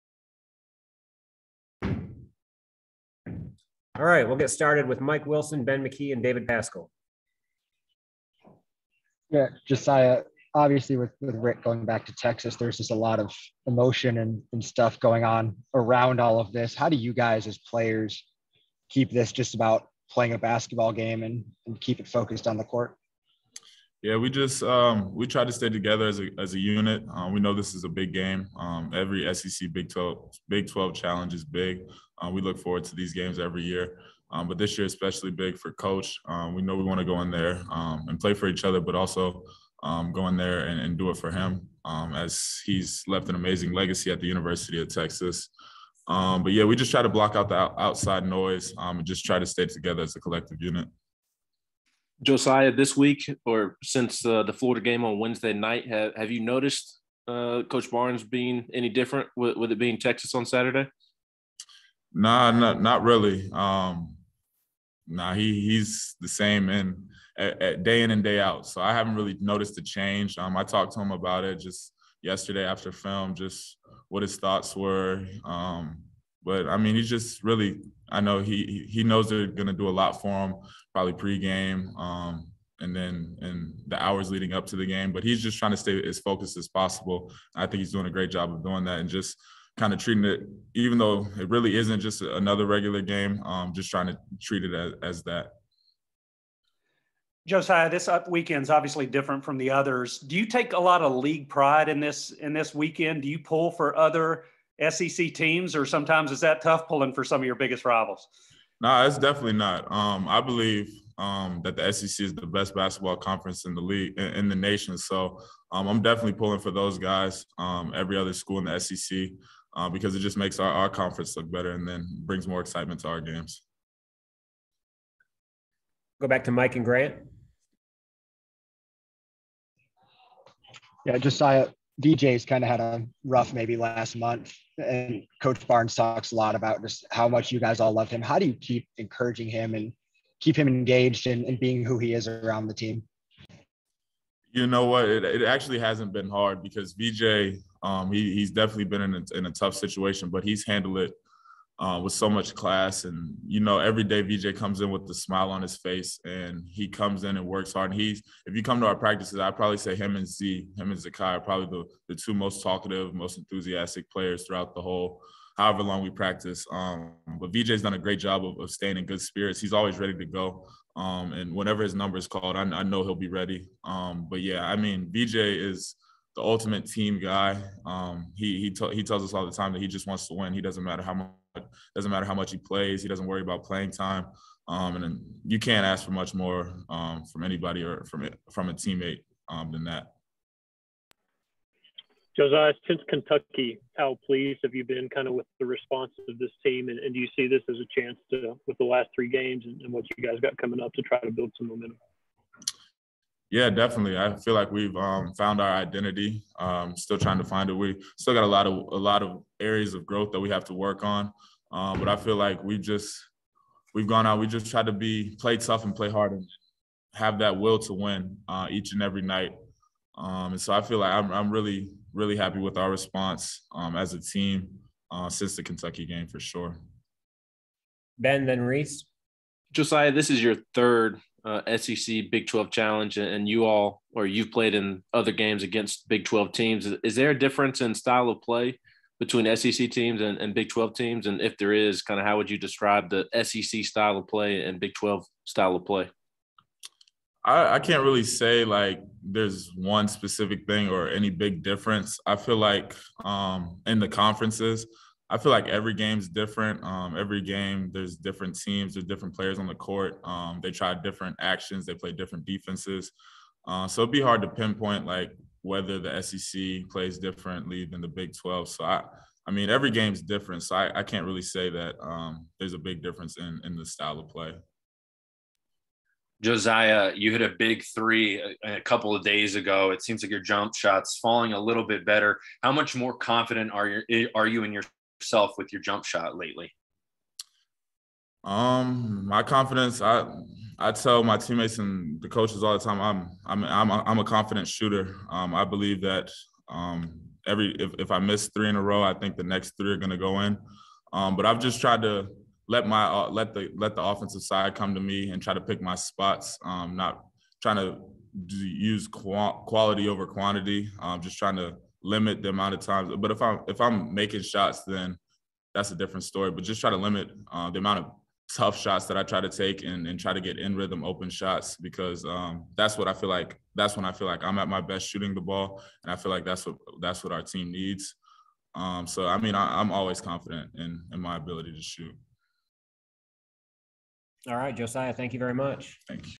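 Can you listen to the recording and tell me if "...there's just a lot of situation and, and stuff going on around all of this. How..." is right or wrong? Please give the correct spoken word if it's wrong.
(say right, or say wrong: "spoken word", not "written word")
wrong: "emotion", not "situation".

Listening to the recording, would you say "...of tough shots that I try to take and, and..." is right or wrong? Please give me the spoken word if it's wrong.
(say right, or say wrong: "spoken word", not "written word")
right.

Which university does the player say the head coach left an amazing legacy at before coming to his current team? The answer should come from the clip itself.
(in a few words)
University of Texas.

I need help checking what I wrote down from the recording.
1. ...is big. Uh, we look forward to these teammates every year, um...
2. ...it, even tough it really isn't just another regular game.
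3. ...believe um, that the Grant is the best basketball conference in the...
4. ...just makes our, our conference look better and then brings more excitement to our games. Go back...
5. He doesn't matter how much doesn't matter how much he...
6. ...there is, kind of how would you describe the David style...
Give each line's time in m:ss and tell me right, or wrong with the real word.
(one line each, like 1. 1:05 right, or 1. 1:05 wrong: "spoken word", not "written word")
1. 0:31 wrong: "games", not "teammates"
2. 1:30 wrong: "though", not "tough"
3. 1:50 wrong: "SEC", not "Grant"
4. 2:00 right
5. 3:00 right
6. 4:01 wrong: "SEC", not "David".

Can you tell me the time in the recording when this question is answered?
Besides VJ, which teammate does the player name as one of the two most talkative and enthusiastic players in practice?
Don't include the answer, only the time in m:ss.
2:40.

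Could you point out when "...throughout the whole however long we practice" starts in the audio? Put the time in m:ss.
2:44.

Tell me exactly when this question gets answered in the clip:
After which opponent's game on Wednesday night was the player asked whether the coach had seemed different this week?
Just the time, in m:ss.
0:54.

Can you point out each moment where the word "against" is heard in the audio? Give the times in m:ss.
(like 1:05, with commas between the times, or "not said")
3:55.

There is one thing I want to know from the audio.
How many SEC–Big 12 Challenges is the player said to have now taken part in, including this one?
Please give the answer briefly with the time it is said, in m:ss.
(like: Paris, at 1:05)
3, at 3:50.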